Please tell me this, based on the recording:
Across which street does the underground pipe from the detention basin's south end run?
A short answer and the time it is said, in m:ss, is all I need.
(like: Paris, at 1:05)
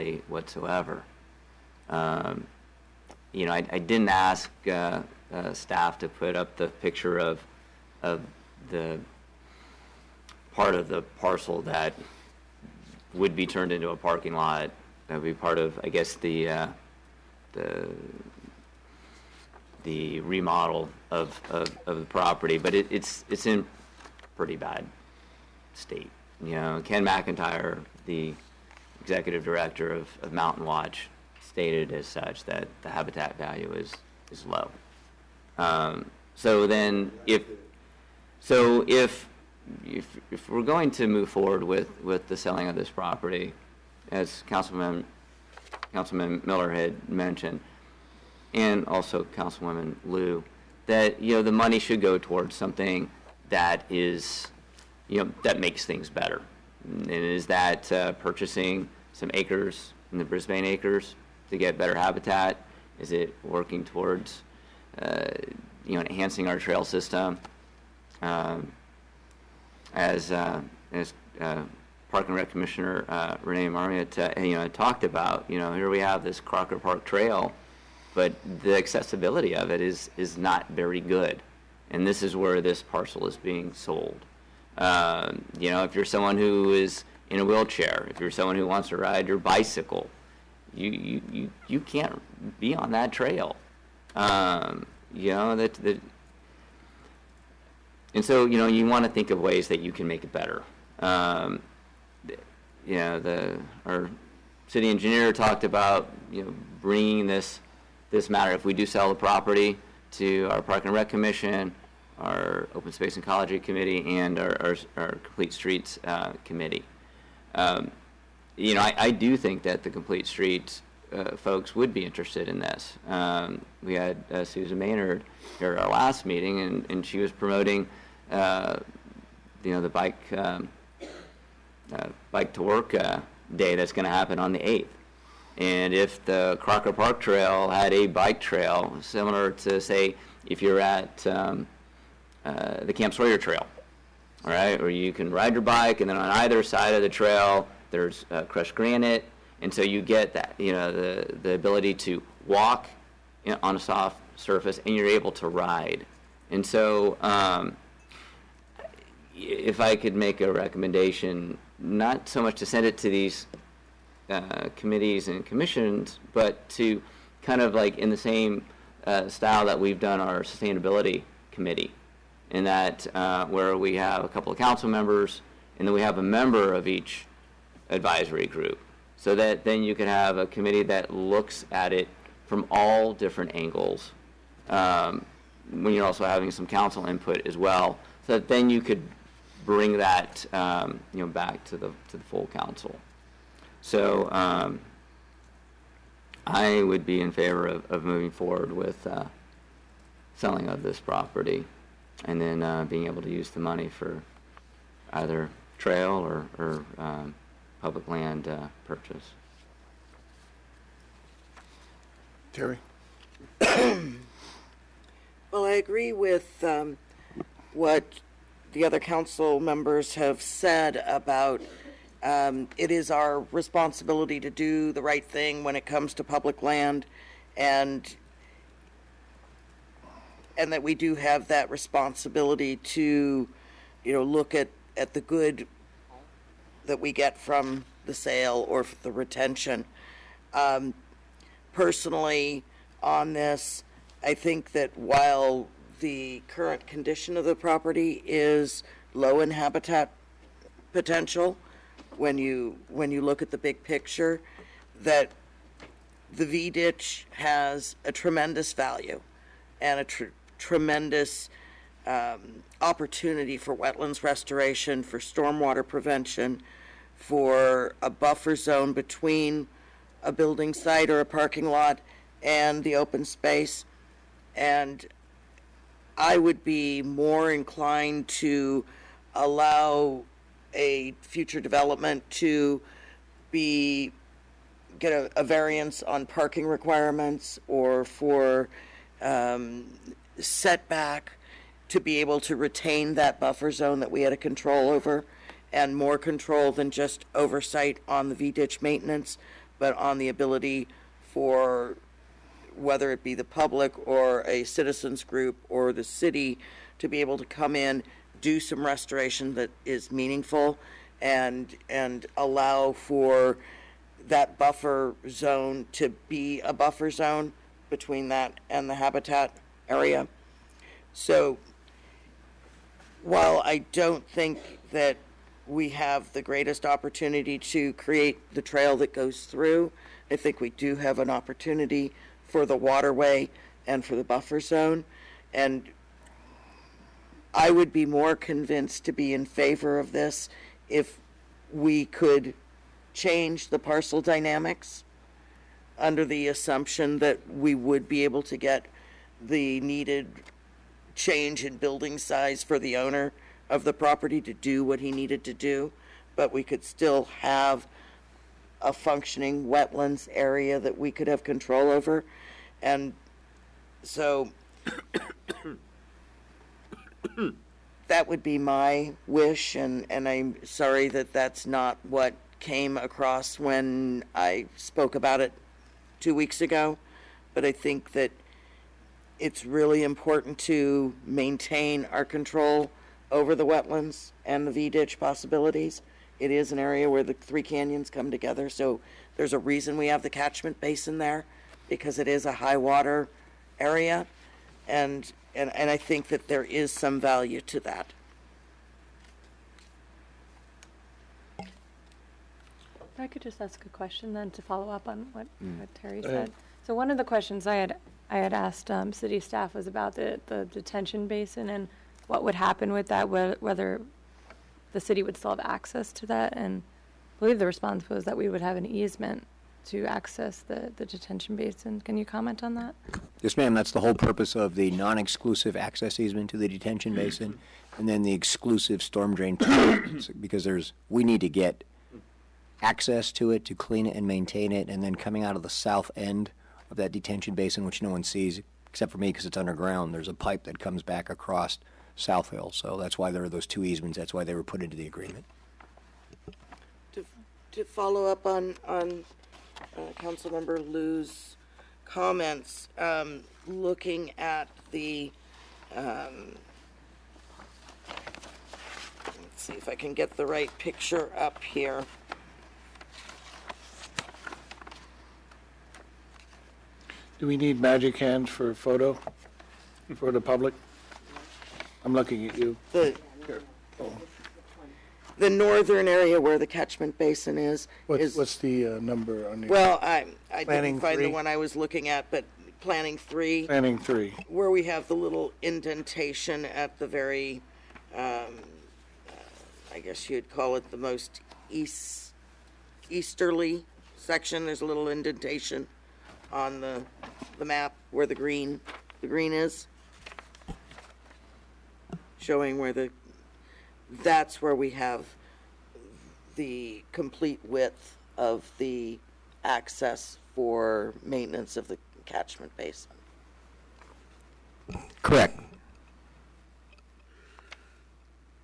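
South Hill, at 7:22.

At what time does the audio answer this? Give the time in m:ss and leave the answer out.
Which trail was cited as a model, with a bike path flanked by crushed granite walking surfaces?
2:22.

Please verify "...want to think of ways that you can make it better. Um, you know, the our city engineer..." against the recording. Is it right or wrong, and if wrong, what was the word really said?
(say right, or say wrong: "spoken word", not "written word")
right.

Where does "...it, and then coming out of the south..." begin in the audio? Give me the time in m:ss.
7:14.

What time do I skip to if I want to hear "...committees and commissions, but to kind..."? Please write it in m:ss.
2:44.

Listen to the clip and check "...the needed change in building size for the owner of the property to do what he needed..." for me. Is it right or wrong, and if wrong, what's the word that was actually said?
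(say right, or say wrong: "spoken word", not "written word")
right.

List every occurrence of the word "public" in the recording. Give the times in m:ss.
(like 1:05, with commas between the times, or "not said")
3:27, 3:46, 5:03, 7:50.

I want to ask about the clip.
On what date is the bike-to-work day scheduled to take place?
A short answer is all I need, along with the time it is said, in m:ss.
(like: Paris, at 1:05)
the 8th, at 2:14.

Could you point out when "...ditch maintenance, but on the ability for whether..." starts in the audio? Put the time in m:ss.
4:58.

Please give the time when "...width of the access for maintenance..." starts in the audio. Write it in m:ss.
8:27.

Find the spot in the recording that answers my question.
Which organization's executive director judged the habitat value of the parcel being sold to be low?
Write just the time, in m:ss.
0:30.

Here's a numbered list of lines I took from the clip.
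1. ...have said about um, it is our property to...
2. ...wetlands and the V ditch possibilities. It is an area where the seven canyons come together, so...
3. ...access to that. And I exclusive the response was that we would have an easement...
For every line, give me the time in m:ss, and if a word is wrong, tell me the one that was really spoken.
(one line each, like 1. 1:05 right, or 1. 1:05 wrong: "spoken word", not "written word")
1. 3:40 wrong: "responsibility", not "property"
2. 6:23 wrong: "three", not "seven"
3. 6:55 wrong: "believe", not "exclusive".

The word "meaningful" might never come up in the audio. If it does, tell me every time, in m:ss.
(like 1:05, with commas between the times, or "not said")
5:10.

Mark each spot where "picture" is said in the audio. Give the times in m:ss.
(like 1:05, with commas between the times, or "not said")
0:06, 4:13, 7:40.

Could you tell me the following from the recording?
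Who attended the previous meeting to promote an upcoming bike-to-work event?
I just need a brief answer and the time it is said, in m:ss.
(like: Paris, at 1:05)
Susan Maynard, at 2:04.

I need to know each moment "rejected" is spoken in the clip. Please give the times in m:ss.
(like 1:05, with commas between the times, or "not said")
not said.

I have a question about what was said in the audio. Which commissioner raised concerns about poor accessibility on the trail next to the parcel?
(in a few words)
Renee Marmiot.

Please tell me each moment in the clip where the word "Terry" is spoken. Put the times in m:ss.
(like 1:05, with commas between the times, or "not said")
3:32, 6:45.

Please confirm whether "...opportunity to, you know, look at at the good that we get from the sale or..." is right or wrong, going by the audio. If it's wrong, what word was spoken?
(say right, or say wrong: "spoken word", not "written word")
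wrong: "responsibility", not "opportunity".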